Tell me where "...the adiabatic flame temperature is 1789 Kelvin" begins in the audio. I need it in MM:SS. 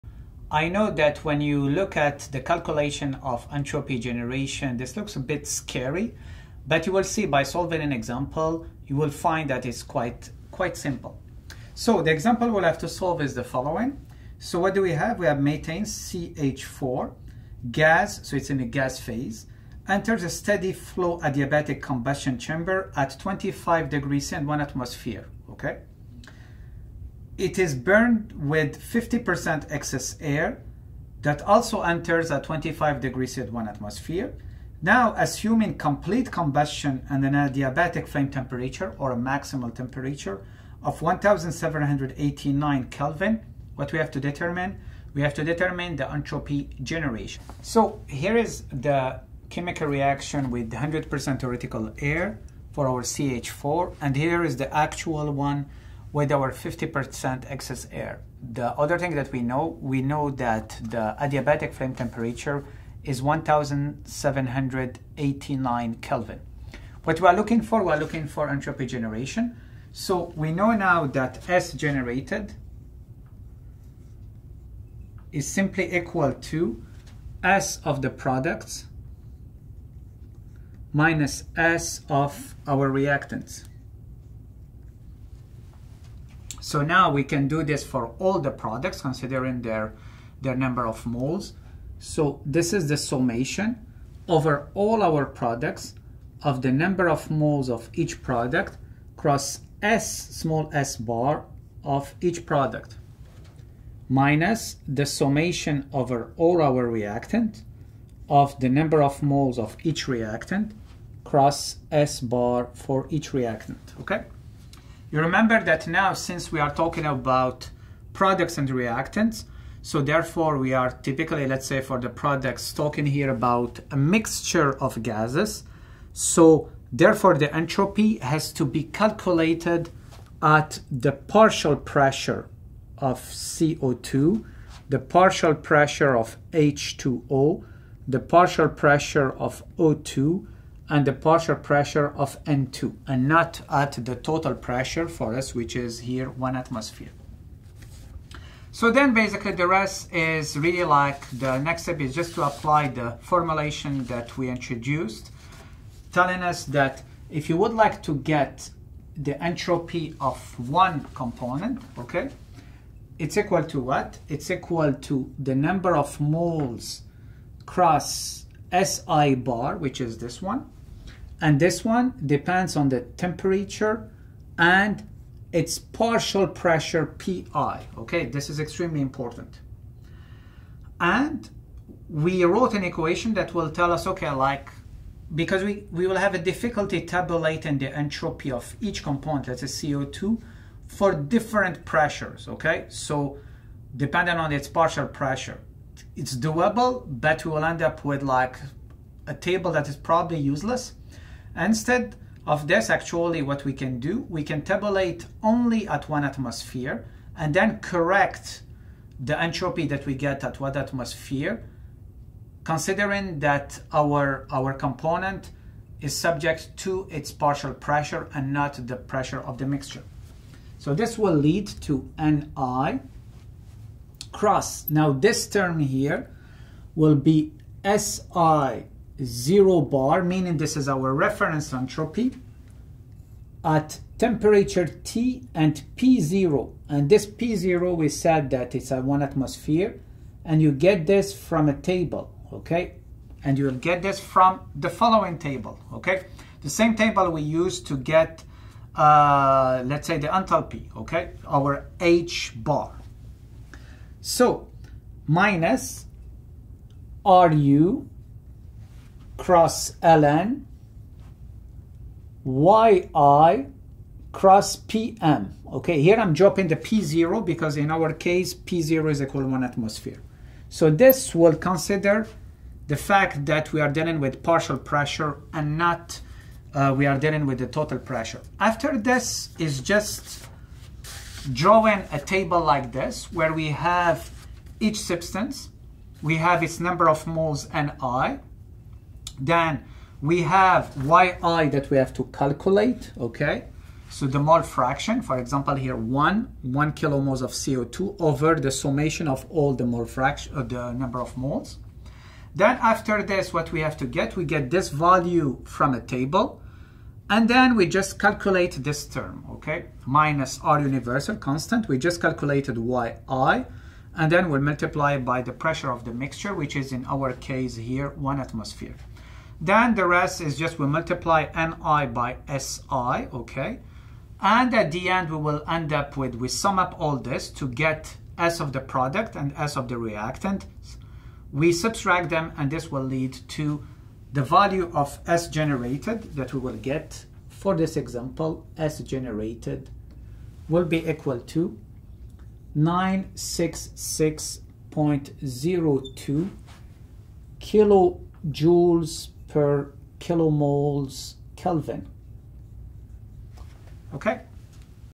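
01:00.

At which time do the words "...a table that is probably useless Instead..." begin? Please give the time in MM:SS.
03:19.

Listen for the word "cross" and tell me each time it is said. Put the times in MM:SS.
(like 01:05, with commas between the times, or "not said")
01:39, 01:51, 02:47, 03:44, 04:19, 04:24.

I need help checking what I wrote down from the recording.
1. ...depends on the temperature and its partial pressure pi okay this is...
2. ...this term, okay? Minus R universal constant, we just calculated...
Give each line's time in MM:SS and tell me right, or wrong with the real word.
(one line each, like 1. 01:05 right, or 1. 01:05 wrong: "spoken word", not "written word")
1. 02:52 right
2. 05:08 right.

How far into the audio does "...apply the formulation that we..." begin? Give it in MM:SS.
02:32.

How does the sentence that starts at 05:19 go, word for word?
Then the rest is just we multiply ni by si, okay?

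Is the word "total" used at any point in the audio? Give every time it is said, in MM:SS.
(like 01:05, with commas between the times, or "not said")
02:24, 04:37.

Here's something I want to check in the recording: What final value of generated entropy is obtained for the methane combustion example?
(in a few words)
966.02 kJ/kmol·K.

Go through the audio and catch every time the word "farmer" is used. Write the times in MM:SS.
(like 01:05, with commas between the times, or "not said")
not said.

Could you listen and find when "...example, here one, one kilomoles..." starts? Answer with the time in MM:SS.
04:55.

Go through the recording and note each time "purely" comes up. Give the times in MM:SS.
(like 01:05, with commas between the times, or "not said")
not said.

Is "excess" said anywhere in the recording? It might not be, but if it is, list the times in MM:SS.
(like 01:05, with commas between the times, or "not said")
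00:29, 00:57.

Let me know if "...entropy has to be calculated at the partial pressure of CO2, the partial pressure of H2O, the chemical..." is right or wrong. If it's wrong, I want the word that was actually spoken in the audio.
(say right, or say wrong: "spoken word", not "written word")
wrong: "partial", not "chemical".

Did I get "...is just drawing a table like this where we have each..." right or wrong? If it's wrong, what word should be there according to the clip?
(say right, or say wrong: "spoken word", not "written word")
right.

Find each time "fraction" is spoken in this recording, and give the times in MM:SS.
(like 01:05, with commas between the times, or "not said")
04:54, 05:00.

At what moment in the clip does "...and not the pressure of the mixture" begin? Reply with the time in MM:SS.
03:38.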